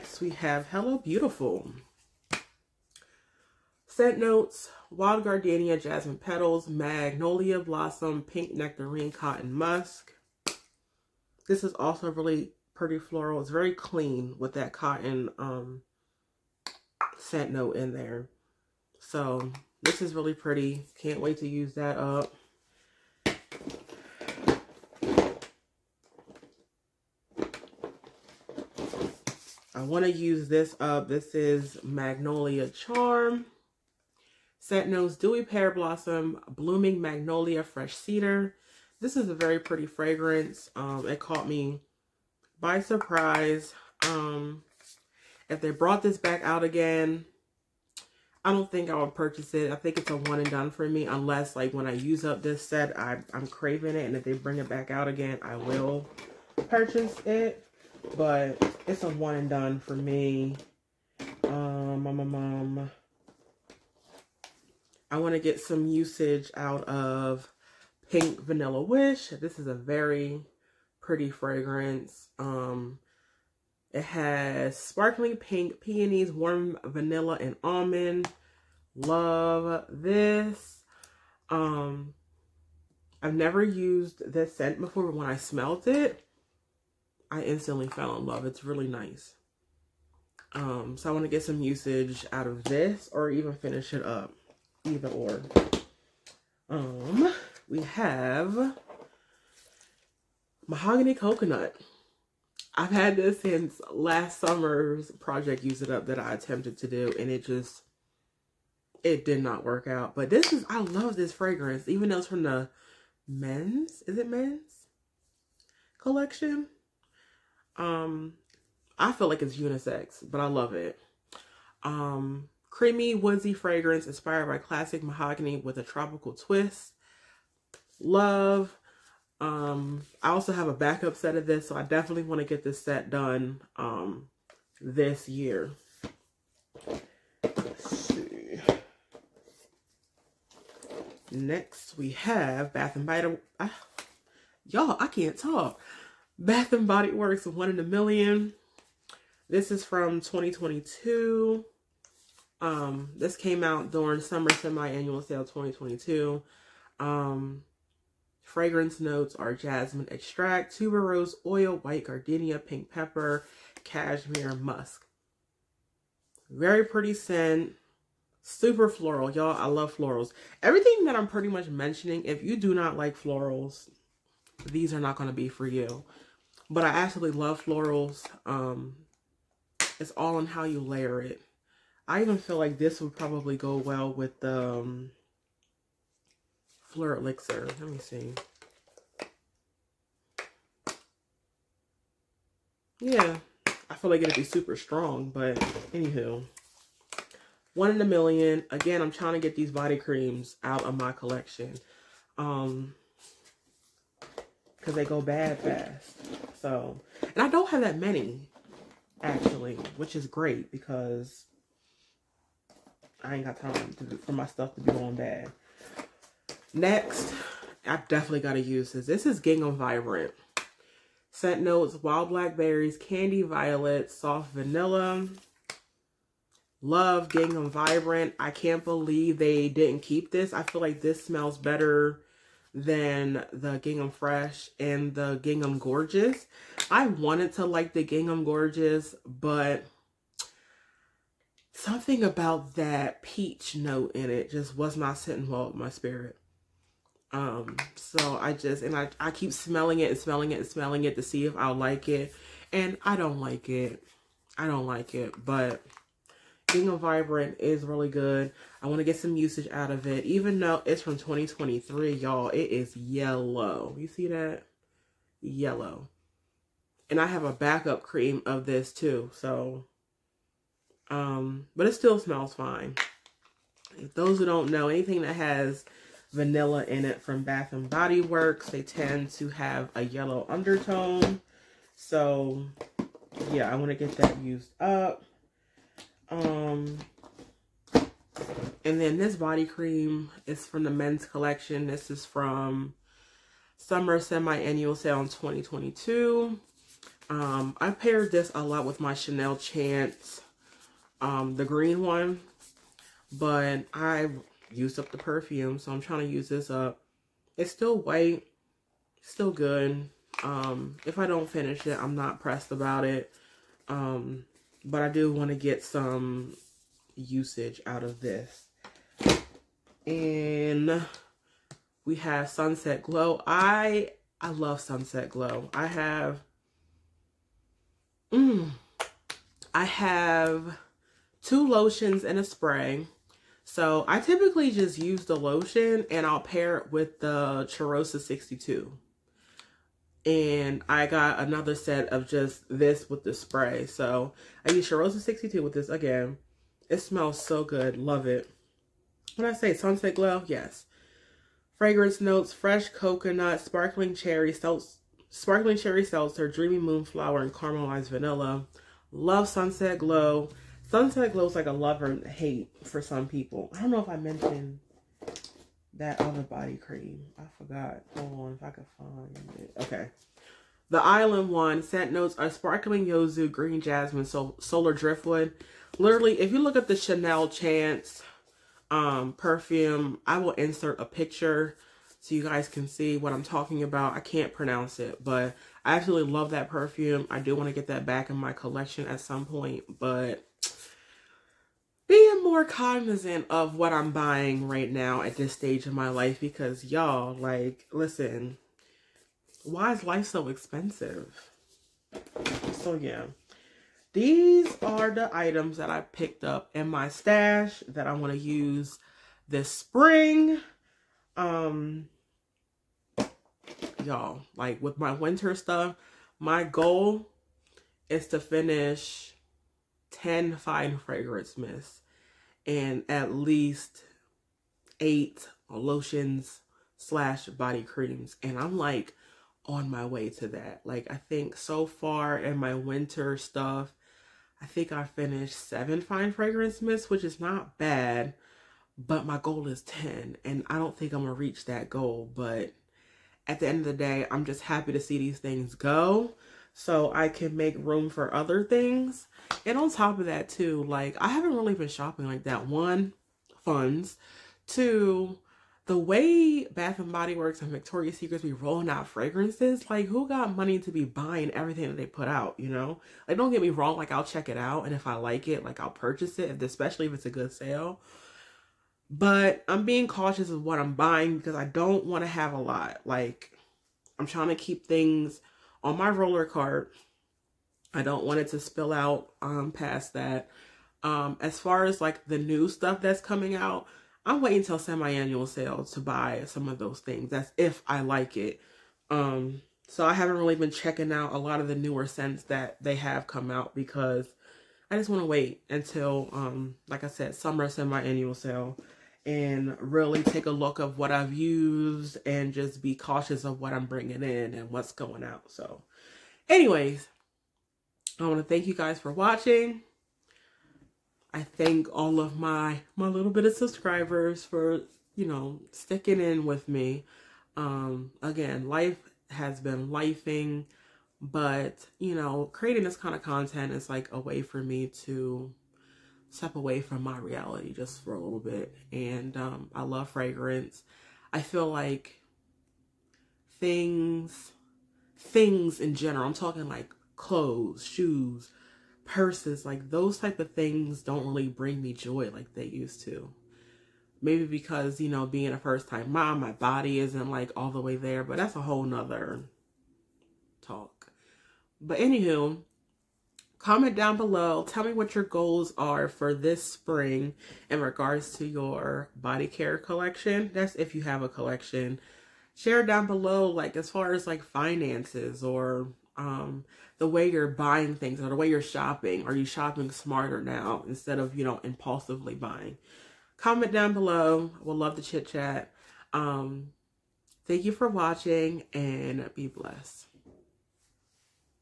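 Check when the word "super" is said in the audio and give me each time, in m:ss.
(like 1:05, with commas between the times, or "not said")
2:48, 3:14.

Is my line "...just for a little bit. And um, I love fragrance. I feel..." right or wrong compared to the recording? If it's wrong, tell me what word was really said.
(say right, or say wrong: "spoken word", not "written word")
right.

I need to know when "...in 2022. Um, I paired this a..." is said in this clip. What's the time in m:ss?
4:55.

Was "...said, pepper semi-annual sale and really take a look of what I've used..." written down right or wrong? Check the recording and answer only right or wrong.
wrong.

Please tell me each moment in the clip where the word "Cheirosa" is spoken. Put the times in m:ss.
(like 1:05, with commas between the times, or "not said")
5:37, 5:44.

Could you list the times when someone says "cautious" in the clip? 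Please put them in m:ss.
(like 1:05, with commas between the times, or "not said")
7:50, 8:22.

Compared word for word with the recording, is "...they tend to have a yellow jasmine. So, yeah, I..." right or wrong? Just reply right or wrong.
wrong.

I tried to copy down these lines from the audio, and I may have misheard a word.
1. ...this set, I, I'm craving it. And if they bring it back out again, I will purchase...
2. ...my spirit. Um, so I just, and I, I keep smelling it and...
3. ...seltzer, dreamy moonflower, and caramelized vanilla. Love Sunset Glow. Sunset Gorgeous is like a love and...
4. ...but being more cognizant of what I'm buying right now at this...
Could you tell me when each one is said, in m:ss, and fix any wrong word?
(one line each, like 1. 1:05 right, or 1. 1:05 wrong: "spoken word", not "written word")
1. 0:52 right
2. 4:05 right
3. 5:56 wrong: "Glow", not "Gorgeous"
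4. 6:29 right.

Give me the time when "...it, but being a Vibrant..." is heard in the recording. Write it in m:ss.
4:15.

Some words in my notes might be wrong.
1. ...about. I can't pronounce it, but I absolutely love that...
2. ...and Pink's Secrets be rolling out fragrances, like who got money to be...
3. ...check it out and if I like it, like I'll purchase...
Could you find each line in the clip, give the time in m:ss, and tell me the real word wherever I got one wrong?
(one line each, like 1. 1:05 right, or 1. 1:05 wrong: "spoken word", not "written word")
1. 6:23 right
2. 7:37 wrong: "Victoria", not "Pink"
3. 7:44 right.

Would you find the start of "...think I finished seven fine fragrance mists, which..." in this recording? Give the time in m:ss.
7:14.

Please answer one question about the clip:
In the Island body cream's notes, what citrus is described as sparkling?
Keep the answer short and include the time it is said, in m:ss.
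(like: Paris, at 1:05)
Yuzu, at 6:12.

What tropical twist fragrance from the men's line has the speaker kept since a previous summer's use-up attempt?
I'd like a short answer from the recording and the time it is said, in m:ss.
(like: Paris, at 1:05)
Mahogany Coconut, at 1:40.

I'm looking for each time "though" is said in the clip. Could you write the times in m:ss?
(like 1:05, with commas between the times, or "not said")
1:52, 4:20.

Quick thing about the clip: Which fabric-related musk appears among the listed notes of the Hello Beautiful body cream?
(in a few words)
Cotton musk.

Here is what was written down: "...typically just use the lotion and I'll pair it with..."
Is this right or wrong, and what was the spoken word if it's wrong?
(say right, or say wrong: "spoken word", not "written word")
right.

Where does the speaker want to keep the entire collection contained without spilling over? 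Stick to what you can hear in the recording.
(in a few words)
Roller cart.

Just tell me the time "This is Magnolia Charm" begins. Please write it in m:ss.
0:31.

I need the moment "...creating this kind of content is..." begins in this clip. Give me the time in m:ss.
8:42.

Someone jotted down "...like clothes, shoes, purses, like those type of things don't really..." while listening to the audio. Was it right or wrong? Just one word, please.
right.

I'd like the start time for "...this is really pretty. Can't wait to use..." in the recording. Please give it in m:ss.
0:19.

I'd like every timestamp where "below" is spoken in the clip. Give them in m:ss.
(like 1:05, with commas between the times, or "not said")
9:14, 9:23, 9:33.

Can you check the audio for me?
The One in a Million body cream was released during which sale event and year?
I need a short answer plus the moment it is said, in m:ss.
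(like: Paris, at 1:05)
Summer Semi-Annual Sale 2022, at 2:34.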